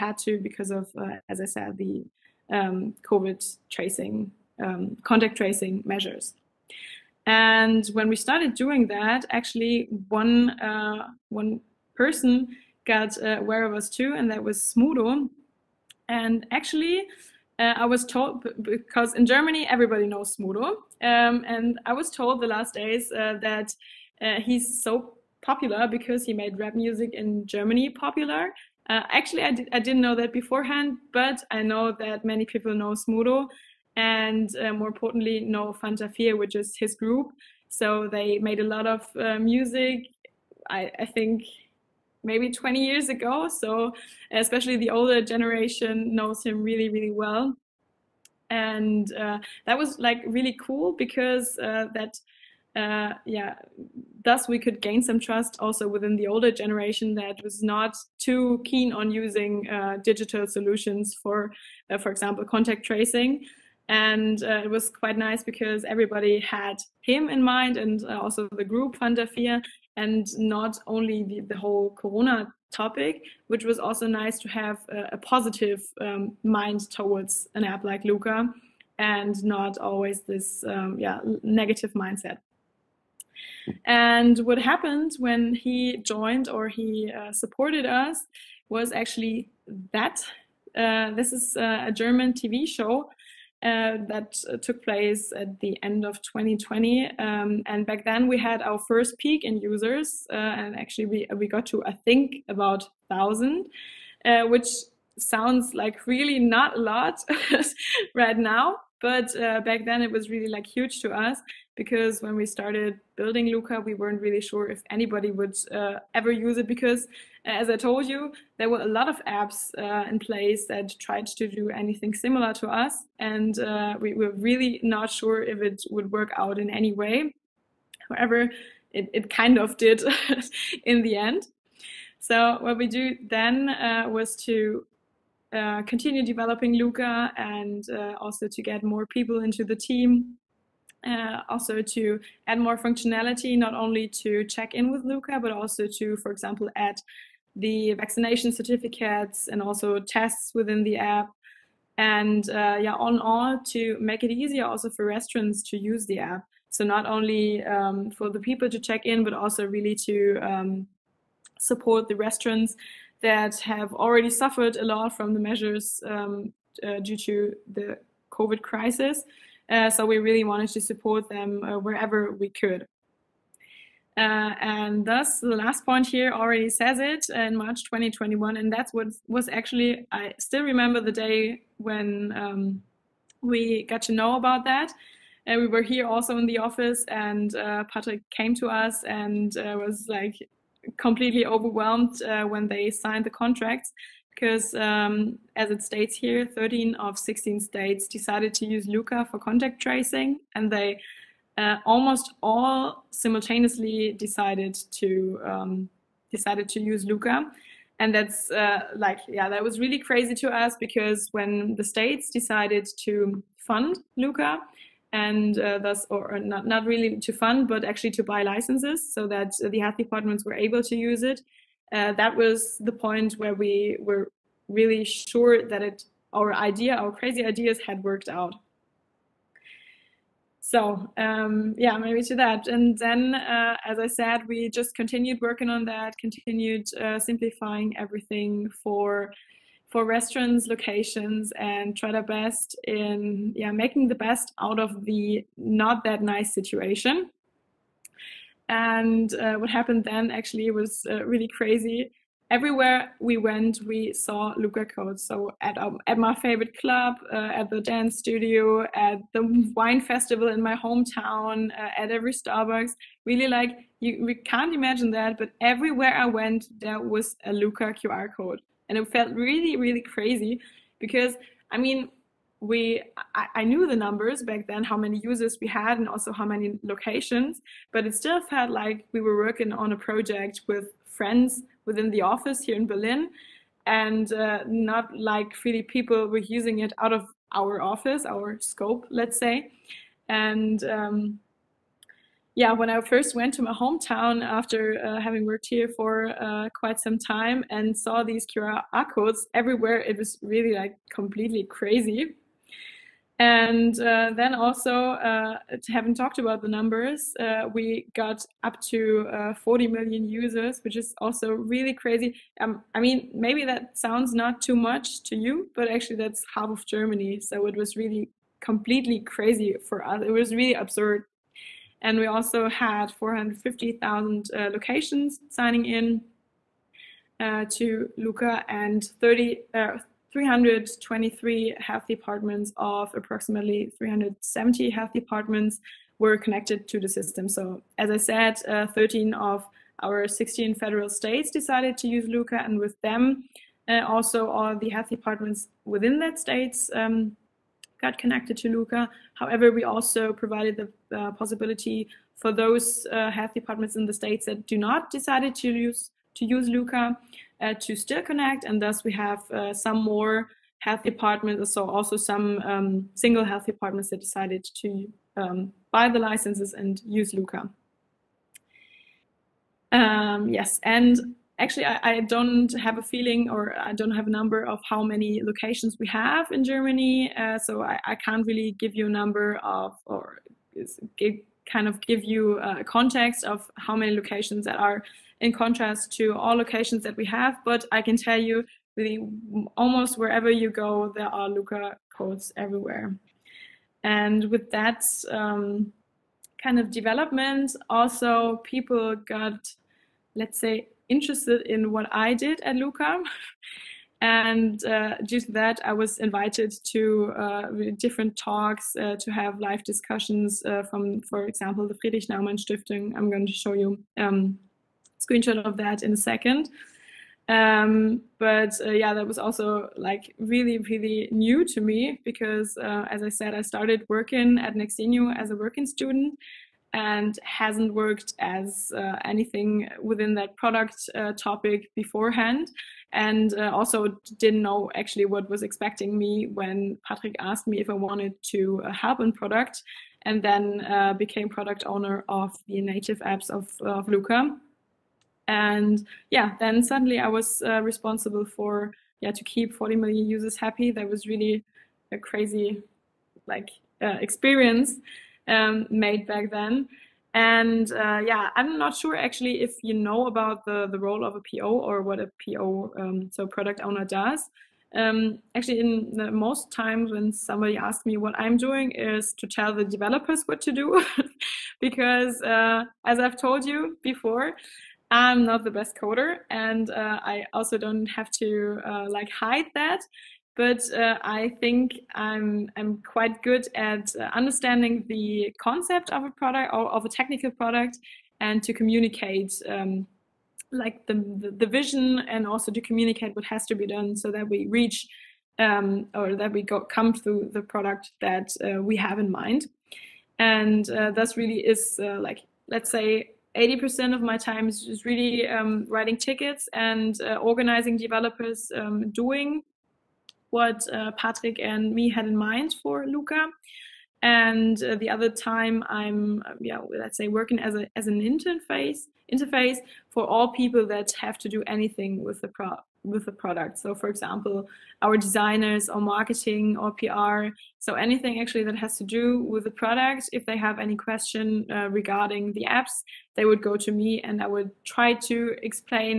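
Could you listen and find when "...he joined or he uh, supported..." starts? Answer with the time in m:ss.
1:25.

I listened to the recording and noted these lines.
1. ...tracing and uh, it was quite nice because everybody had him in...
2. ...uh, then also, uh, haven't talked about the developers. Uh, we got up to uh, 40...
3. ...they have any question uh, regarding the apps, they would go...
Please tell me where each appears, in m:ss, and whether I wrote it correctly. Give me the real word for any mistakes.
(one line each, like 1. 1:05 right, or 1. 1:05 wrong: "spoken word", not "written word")
1. 1:02 right
2. 5:03 wrong: "numbers", not "developers"
3. 8:50 right.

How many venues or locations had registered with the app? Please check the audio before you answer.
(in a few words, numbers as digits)
450,000.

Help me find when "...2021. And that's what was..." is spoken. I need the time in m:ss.
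2:57.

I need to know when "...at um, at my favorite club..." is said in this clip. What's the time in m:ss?
4:15.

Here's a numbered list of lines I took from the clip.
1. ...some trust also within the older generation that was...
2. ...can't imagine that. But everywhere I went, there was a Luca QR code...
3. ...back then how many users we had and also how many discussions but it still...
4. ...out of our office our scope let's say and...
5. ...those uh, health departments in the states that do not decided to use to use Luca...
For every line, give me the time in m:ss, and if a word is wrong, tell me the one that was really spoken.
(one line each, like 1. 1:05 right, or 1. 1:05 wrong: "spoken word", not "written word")
1. 0:55 right
2. 4:24 right
3. 4:34 wrong: "locations", not "discussions"
4. 4:46 right
5. 5:52 right.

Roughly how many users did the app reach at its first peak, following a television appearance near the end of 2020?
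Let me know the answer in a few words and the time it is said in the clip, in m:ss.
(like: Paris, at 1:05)
1000, at 1:43.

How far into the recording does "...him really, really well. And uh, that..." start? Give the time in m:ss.
0:46.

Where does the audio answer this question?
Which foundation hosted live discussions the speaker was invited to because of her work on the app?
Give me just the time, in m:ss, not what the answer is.
6:51.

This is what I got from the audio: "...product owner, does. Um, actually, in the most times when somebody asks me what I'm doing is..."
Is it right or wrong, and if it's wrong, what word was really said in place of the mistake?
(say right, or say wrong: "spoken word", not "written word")
right.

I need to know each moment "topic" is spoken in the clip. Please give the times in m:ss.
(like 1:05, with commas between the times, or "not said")
1:12, 7:11.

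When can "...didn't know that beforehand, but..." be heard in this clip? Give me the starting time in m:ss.
0:29.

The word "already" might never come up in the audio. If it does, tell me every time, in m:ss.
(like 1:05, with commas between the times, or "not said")
2:43, 2:56.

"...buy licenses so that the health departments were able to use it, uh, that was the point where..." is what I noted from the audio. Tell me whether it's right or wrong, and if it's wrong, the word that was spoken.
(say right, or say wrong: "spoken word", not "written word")
right.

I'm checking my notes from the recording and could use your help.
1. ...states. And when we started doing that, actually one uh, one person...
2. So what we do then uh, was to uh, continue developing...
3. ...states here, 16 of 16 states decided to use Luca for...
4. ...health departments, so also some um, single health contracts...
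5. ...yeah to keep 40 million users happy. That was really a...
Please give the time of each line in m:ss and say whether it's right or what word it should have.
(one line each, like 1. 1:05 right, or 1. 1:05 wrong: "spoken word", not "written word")
1. 0:05 wrong: "measures", not "states"
2. 2:12 right
3. 3:15 wrong: "13", not "16"
4. 6:00 wrong: "departments", not "contracts"
5. 7:29 right.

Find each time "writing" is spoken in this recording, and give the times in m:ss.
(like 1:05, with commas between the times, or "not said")
8:25.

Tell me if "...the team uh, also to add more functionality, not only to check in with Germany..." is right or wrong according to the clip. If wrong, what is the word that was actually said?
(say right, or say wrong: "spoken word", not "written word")
wrong: "Luca", not "Germany".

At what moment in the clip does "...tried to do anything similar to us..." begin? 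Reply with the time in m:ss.
2:00.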